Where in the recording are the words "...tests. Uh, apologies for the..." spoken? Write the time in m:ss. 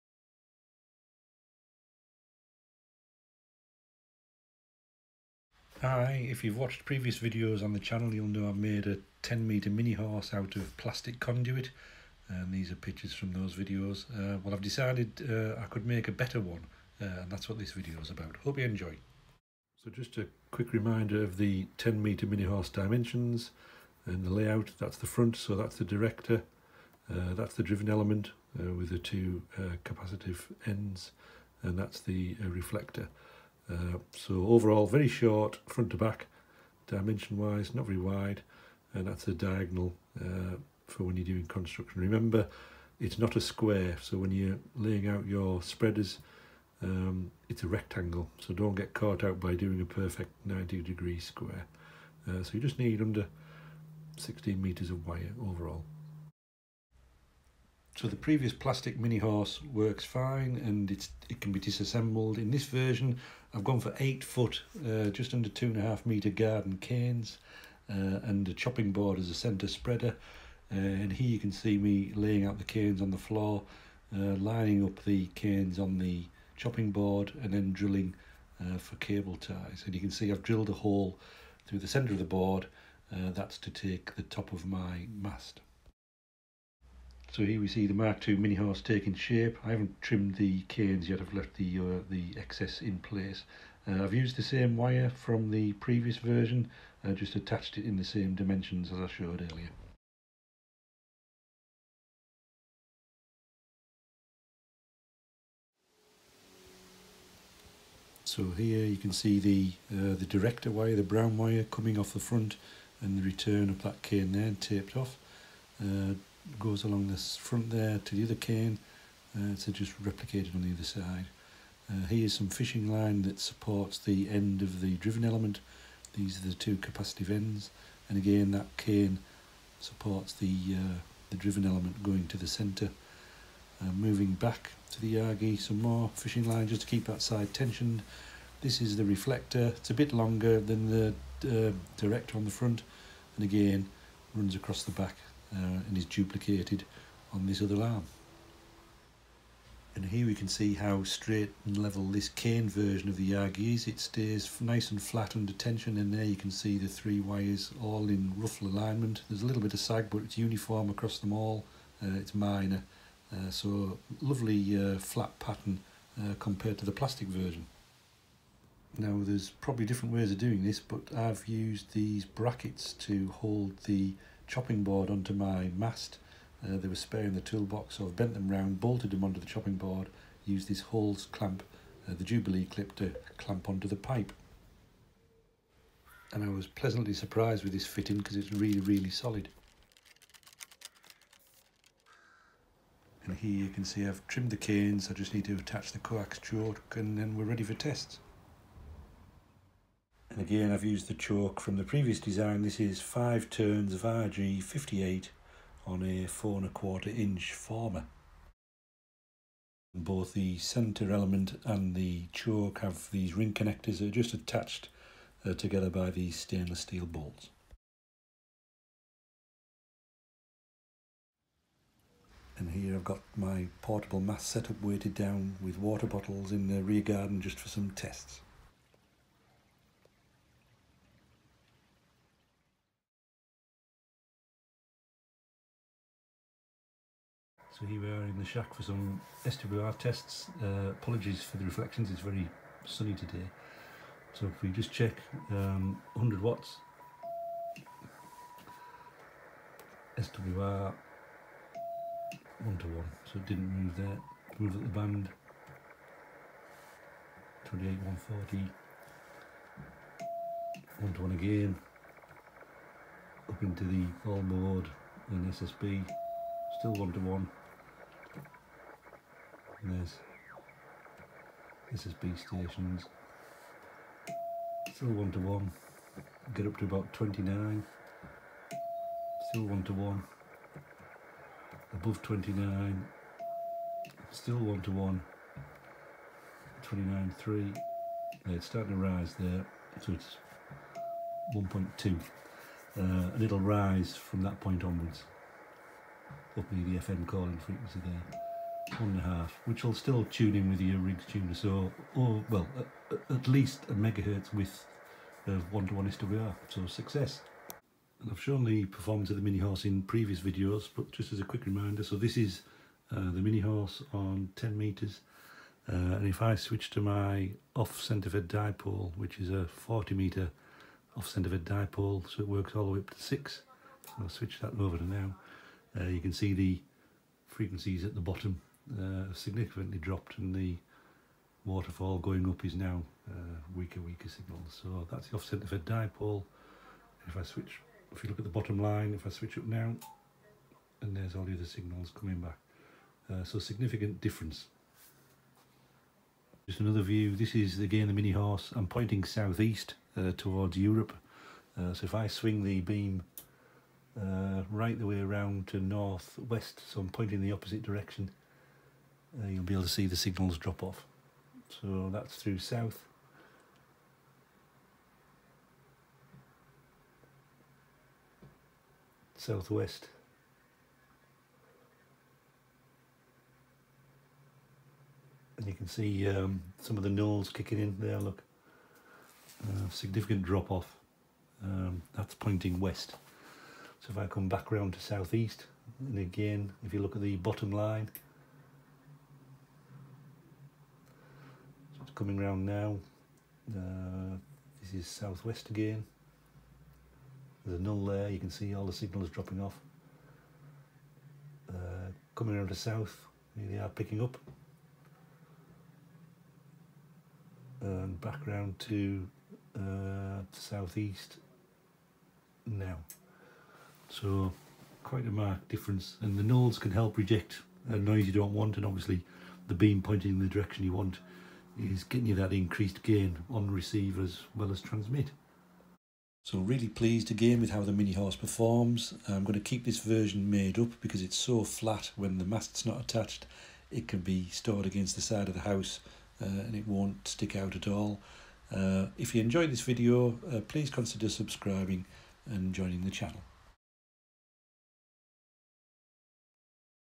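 3:59.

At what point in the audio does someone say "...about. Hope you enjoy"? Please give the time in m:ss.
0:18.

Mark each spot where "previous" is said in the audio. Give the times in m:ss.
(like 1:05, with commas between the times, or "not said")
0:06, 0:58, 1:35, 3:21, 5:10.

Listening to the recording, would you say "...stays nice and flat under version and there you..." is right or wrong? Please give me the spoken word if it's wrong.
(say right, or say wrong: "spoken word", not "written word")
wrong: "tension", not "version".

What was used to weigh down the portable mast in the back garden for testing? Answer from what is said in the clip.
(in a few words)
Water bottles.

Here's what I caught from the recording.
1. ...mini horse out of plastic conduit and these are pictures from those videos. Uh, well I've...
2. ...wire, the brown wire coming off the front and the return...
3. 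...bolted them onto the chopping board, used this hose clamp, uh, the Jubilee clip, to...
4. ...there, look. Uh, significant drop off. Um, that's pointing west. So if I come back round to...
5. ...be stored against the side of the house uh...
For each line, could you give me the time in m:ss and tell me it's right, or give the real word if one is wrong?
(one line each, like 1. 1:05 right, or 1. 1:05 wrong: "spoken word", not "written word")
1. 0:09 right
2. 1:50 right
3. 2:58 right
4. 6:17 right
5. 7:14 right.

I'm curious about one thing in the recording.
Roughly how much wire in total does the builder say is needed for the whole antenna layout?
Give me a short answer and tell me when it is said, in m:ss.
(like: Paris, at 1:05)
Under 16 meters, at 0:53.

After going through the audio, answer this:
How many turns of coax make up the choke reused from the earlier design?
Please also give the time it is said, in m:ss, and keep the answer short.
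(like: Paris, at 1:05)
5, at 3:23.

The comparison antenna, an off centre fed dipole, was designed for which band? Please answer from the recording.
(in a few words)
40 meters.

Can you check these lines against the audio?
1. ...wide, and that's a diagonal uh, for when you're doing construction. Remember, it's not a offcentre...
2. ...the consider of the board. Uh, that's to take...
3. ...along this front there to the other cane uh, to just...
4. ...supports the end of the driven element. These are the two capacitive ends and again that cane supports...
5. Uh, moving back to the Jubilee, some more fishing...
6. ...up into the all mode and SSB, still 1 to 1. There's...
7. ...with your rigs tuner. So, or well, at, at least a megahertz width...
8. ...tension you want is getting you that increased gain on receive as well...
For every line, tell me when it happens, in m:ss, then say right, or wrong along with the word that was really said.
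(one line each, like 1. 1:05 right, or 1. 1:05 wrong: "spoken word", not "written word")
1. 0:37 wrong: "square", not "offcentre"
2. 1:21 wrong: "center", not "consider"
3. 1:56 right
4. 2:03 right
5. 2:13 wrong: "Yagi", not "Jubilee"
6. 4:23 right
7. 5:00 right
8. 7:00 wrong: "direction", not "tension".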